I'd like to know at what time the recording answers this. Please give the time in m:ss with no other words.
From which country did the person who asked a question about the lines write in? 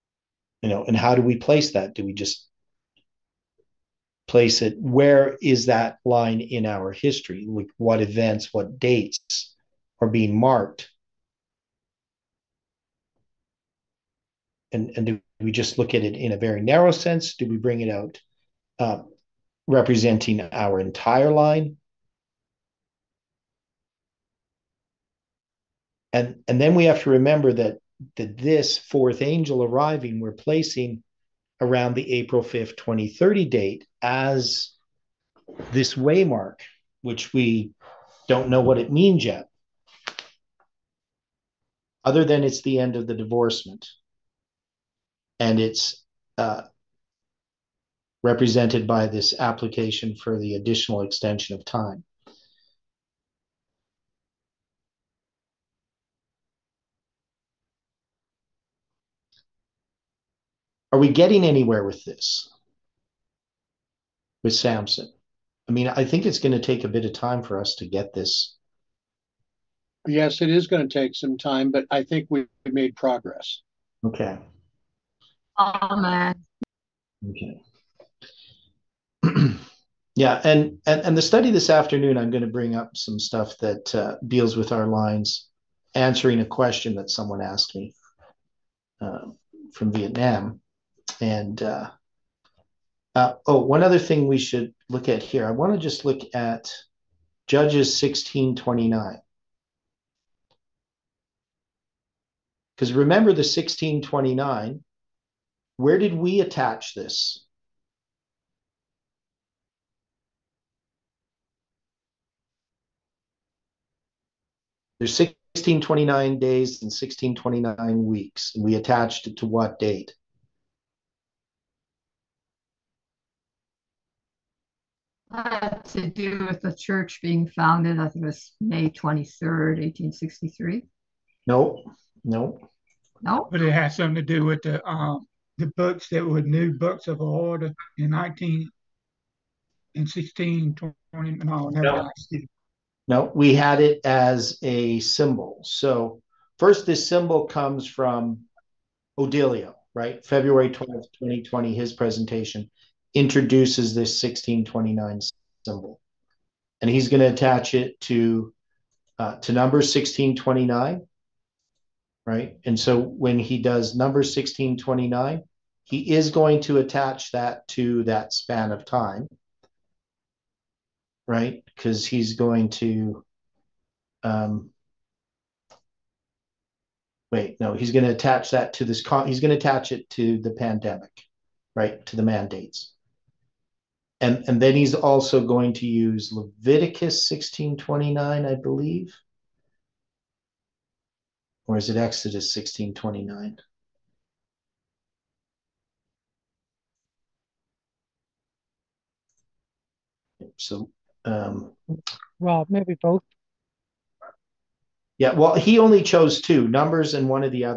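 1:29.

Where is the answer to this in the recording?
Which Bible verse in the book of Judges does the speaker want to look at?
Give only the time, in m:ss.
1:37.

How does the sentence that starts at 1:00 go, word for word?
Are we getting anywhere with this, with Samson?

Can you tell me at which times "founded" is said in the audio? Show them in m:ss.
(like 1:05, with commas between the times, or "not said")
2:07.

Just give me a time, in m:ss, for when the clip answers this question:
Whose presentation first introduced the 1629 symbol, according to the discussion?
2:29.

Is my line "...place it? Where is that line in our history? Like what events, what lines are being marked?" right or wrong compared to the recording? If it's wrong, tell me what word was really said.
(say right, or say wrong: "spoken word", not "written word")
wrong: "dates", not "lines".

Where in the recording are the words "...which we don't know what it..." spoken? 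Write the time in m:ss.
0:37.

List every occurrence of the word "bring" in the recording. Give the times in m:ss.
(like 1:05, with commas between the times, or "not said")
0:17, 1:22.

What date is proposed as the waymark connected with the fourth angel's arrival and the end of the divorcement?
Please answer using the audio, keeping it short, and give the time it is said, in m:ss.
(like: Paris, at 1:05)
April 5, 2030, at 0:32.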